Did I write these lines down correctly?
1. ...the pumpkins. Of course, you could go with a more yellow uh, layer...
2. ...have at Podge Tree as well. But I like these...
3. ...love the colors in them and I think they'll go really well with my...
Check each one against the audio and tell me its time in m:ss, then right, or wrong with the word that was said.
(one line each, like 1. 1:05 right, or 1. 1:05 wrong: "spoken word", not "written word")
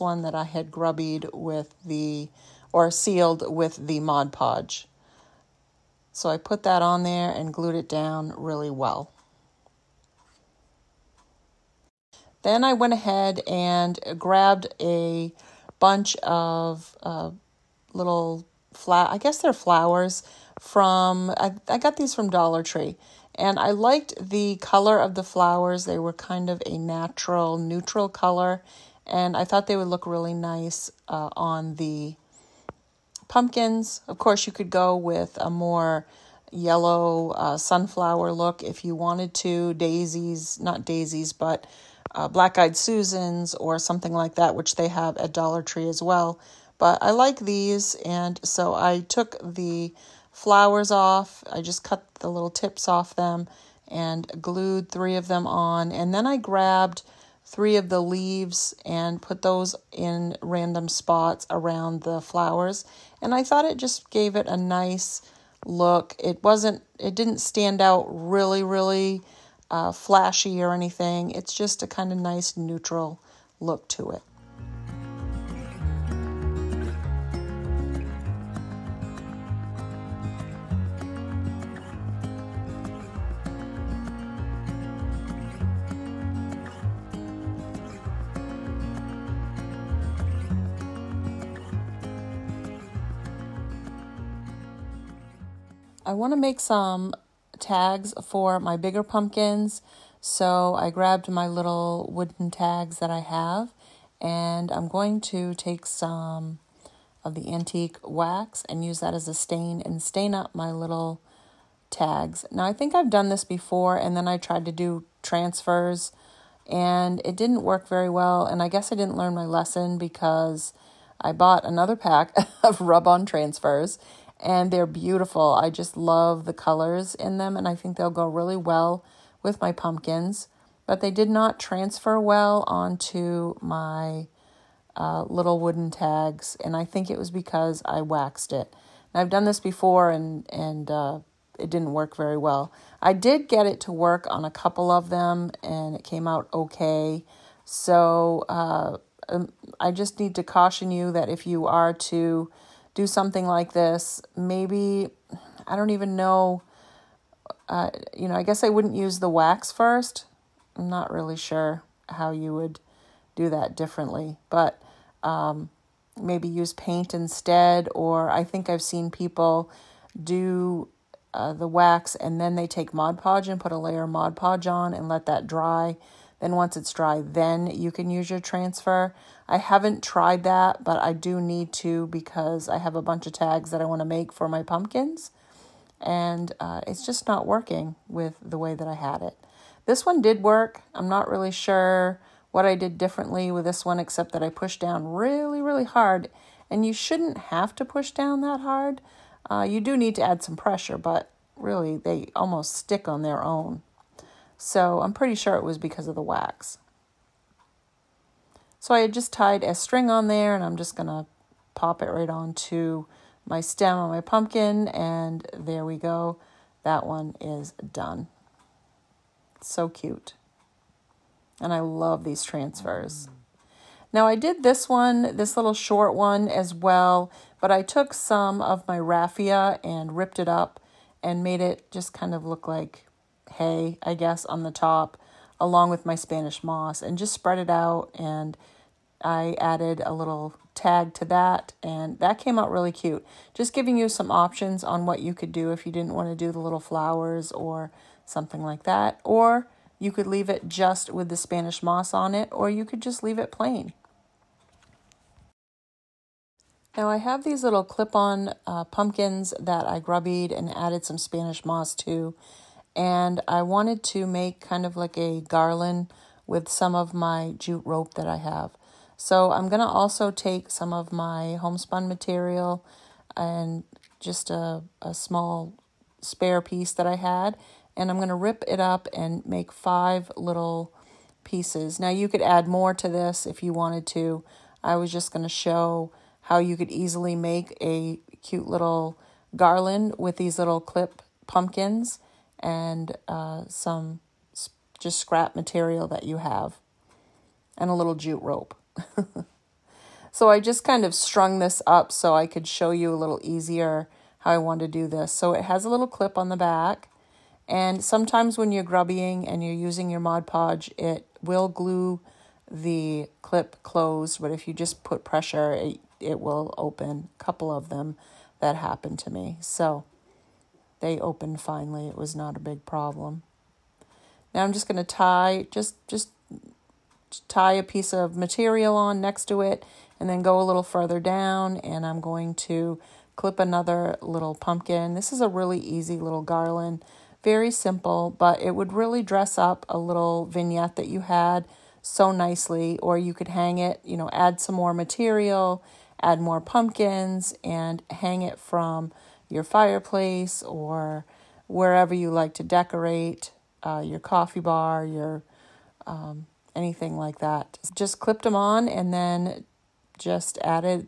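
1. 0:31 wrong: "sunflower", not "layer"
2. 0:44 wrong: "Dollar", not "Podge"
3. 2:05 right.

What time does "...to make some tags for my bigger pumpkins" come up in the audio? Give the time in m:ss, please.
1:36.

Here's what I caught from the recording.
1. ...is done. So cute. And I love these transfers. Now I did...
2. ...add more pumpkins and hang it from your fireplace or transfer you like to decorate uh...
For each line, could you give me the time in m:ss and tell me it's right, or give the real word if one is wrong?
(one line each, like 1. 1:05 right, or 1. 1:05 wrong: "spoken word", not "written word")
1. 3:37 right
2. 5:46 wrong: "wherever", not "transfer".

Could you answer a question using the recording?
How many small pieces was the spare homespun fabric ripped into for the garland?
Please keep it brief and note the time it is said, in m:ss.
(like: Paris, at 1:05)
5, at 4:39.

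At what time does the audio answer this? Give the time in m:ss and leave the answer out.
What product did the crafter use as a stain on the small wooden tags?
1:47.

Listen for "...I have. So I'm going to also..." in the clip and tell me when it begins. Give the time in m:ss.
4:28.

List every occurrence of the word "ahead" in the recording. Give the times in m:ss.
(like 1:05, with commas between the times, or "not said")
0:12.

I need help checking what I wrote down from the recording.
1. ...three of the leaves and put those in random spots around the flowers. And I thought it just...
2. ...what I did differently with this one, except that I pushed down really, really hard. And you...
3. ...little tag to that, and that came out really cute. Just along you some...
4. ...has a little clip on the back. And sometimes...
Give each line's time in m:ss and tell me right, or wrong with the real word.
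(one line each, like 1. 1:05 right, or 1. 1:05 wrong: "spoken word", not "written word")
1. 0:57 right
2. 3:12 right
3. 4:00 wrong: "giving", not "along"
4. 5:05 right.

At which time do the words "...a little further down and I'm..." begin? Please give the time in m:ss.
5:30.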